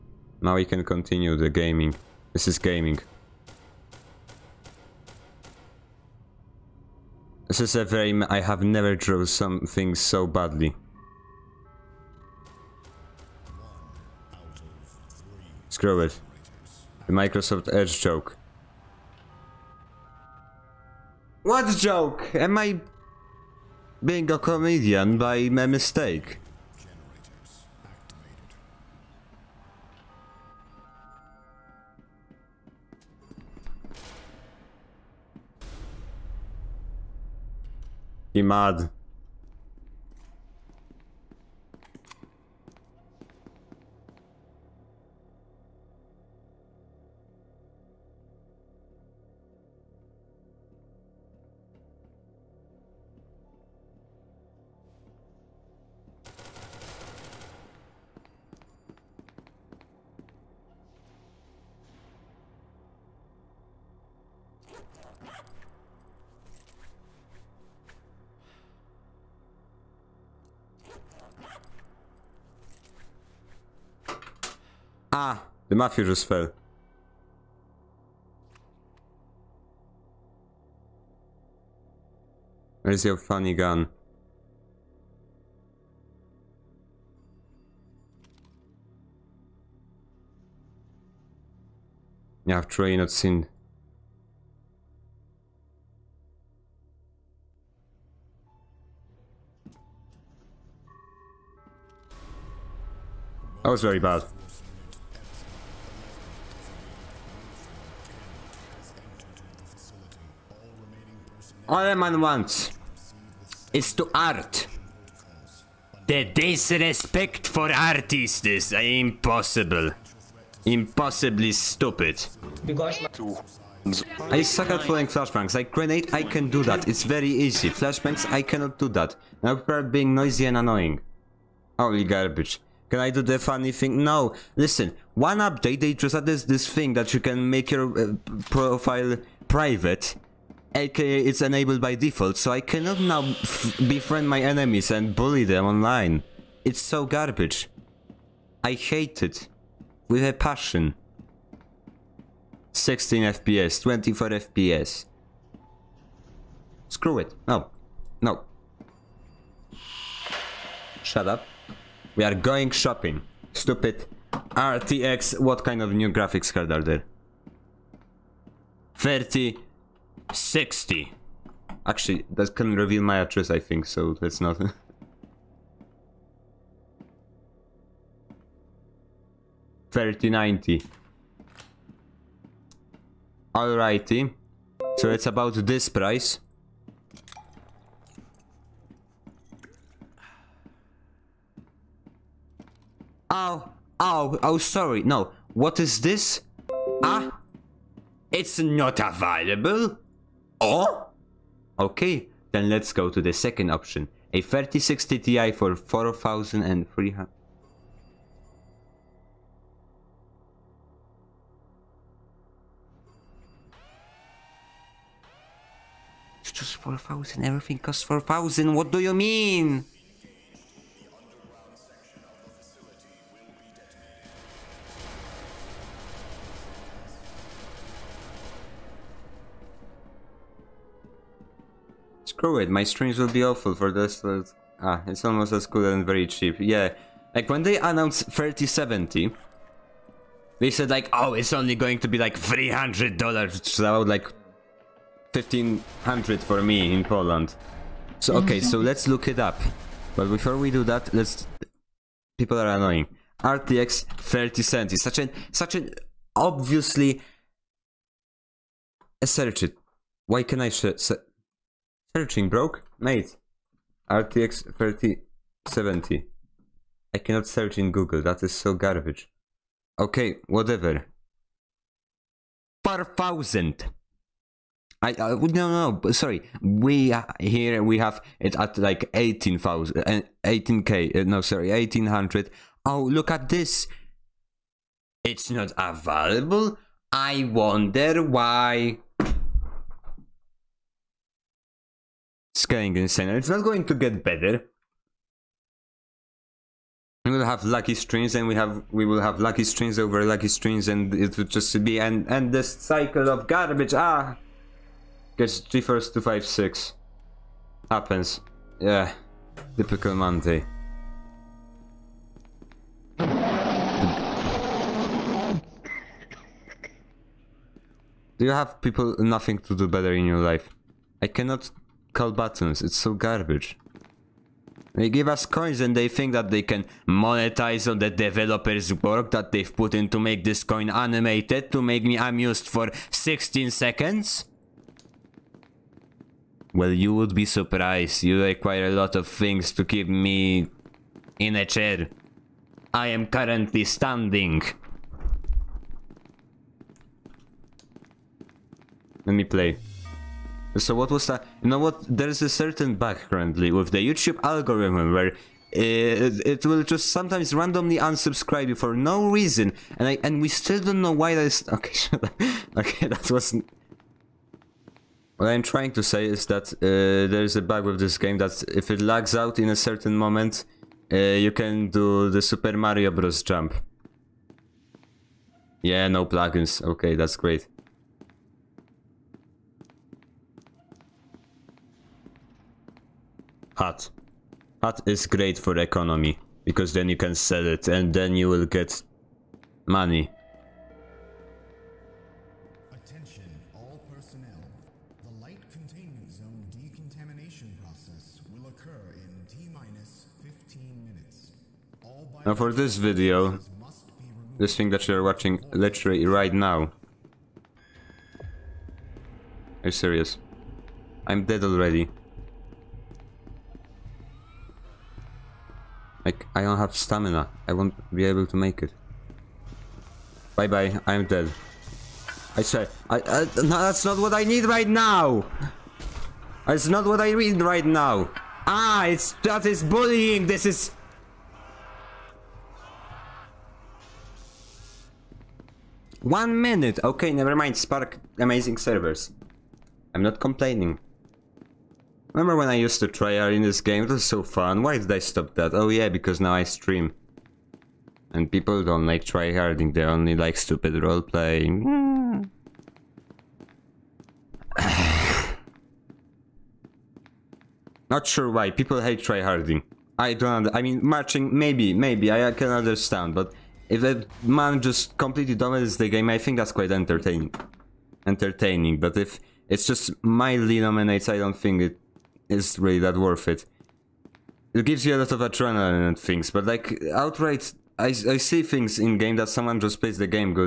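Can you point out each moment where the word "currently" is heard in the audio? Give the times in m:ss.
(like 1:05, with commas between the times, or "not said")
5:43, 5:53.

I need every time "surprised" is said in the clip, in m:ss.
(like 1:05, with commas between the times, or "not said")
5:37.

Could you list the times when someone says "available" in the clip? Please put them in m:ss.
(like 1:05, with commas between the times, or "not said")
3:18, 4:45.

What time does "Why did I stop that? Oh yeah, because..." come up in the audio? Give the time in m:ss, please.
7:24.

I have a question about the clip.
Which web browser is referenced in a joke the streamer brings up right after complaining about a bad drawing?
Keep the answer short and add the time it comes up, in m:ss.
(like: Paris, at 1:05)
Microsoft Edge, at 0:17.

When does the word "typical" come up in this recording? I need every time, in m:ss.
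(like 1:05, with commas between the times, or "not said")
5:09.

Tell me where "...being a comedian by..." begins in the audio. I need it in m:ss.
0:24.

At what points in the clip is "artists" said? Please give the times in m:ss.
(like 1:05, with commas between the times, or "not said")
1:57.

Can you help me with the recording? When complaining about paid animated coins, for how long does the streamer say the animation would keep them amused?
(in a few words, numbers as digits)
16 seconds.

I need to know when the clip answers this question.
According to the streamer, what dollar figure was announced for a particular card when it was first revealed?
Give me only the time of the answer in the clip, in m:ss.
4:02.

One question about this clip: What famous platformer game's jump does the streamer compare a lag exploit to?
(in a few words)
Super Mario Bros.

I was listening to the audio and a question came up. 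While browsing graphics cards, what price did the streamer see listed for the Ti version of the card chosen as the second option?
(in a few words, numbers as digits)
4300.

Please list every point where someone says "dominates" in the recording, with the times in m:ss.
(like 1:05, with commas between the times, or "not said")
7:45, 7:50.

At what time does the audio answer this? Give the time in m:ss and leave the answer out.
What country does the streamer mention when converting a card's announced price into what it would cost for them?
4:07.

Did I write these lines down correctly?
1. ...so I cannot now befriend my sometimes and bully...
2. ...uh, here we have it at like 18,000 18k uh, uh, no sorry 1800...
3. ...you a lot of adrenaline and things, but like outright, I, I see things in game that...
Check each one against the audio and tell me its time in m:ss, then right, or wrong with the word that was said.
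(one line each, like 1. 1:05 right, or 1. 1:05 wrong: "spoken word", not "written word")
1. 2:22 wrong: "enemies", not "sometimes"
2. 4:37 right
3. 7:55 right.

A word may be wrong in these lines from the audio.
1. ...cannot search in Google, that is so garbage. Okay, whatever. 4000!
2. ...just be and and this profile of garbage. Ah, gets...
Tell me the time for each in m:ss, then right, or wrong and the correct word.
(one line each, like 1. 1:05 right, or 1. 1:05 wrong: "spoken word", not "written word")
1. 4:27 right
2. 5:01 wrong: "cycle", not "profile".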